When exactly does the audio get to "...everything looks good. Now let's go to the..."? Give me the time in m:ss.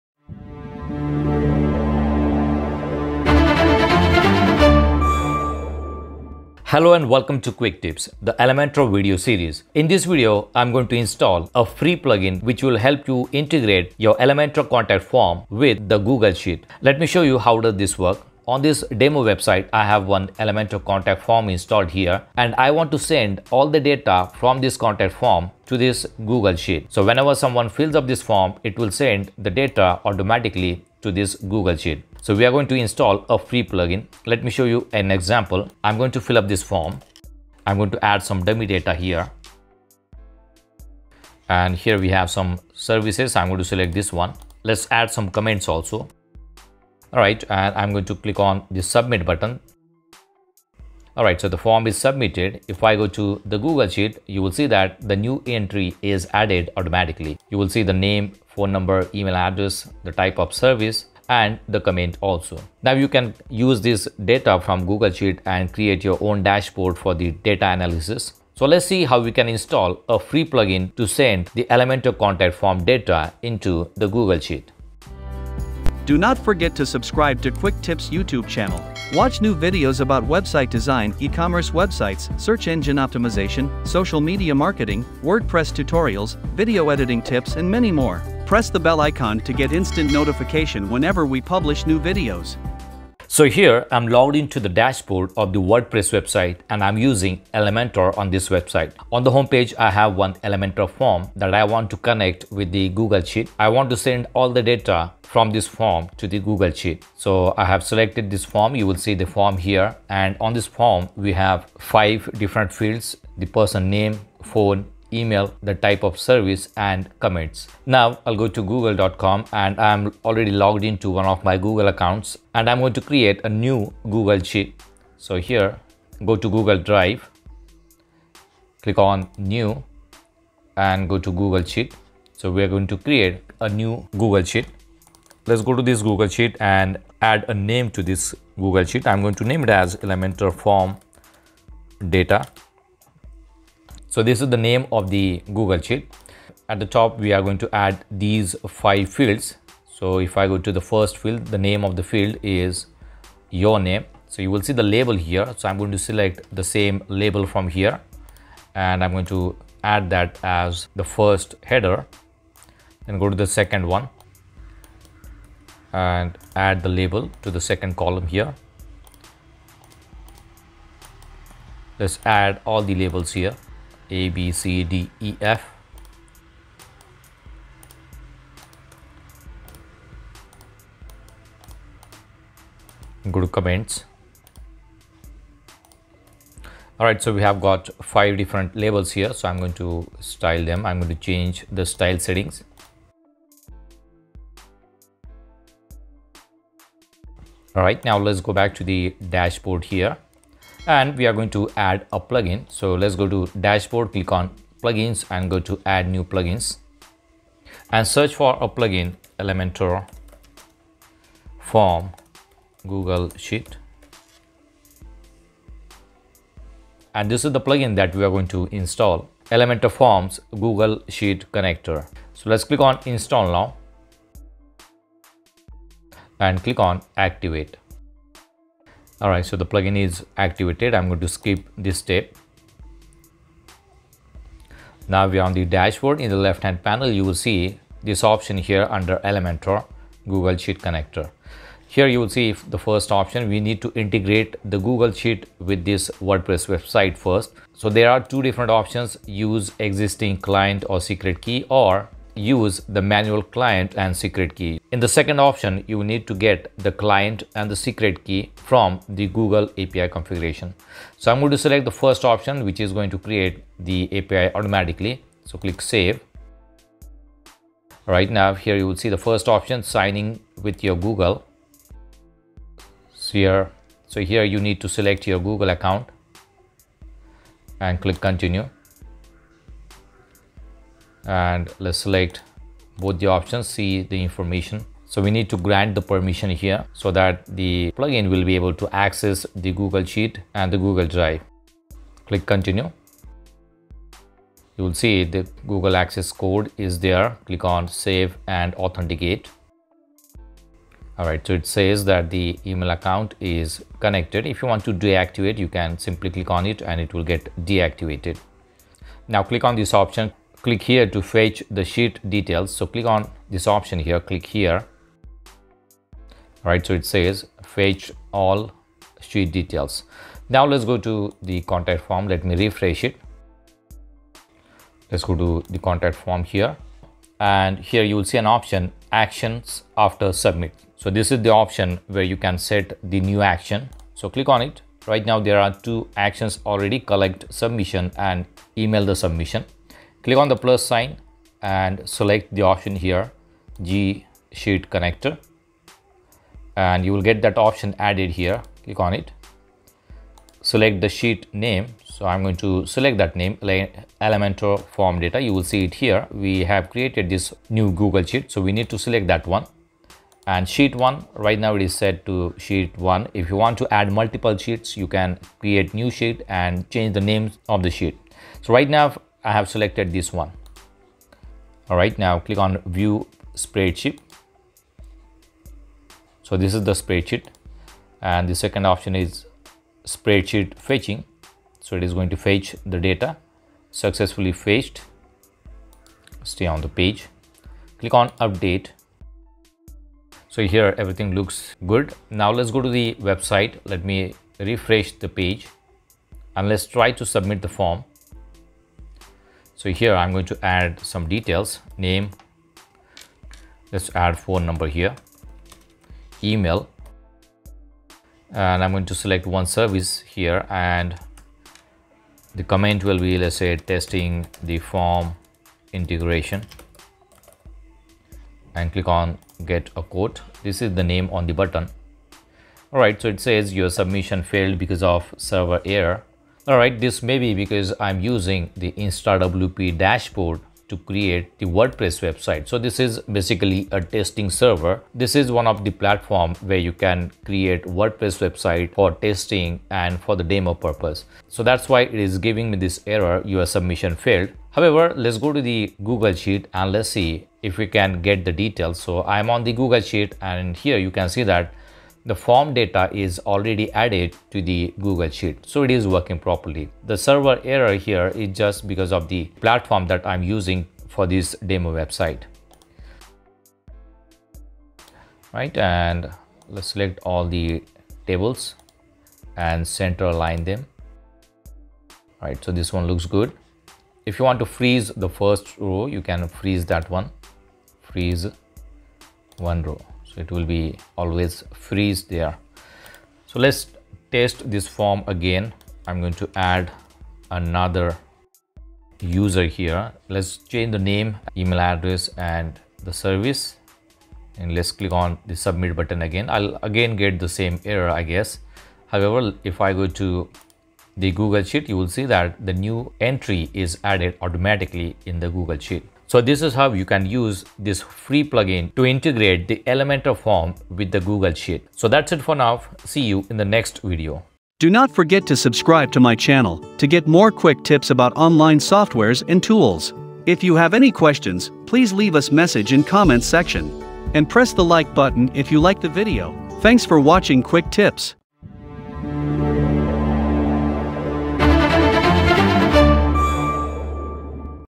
6:30.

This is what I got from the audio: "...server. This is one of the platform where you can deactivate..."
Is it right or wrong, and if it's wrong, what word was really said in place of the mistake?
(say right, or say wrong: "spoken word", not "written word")
wrong: "create", not "deactivate".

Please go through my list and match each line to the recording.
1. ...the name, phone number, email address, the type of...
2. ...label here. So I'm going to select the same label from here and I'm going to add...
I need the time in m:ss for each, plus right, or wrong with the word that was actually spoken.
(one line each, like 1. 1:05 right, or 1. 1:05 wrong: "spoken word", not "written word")
1. 0:57 right
2. 2:34 right.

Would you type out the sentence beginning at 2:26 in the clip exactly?
At the top, we are going to add these five fields.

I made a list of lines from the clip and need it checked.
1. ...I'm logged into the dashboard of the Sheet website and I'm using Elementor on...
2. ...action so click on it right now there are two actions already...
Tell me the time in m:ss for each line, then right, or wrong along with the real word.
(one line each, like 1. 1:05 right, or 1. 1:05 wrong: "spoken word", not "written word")
1. 1:33 wrong: "WordPress", not "Sheet"
2. 5:33 right.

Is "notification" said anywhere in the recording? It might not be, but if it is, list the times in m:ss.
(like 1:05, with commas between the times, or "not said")
1:30.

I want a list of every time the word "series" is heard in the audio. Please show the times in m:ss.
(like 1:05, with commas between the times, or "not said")
0:09.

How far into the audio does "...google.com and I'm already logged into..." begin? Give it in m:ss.
1:58.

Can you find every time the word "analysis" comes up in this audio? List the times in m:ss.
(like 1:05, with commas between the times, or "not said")
1:07.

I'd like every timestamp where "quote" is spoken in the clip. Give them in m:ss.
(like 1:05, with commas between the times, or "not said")
7:00.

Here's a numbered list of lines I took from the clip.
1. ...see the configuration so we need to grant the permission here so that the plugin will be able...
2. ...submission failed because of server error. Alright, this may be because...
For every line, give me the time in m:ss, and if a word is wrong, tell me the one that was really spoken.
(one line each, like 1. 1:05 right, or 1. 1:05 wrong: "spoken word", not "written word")
1. 4:43 wrong: "information", not "configuration"
2. 7:03 right.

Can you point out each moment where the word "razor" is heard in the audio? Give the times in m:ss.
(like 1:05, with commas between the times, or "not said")
not said.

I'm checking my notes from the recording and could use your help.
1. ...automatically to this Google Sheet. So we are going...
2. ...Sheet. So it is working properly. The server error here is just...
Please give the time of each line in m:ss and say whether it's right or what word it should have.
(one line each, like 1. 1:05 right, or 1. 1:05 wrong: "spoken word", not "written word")
1. 0:30 right
2. 7:35 right.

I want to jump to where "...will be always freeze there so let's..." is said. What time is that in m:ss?
8:00.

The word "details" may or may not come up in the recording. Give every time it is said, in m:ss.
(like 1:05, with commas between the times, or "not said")
5:12, 5:19, 6:41, 7:28.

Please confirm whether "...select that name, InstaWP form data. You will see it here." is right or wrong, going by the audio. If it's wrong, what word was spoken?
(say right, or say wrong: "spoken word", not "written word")
wrong: "Elementor", not "InstaWP".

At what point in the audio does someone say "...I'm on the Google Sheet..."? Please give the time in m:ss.
7:29.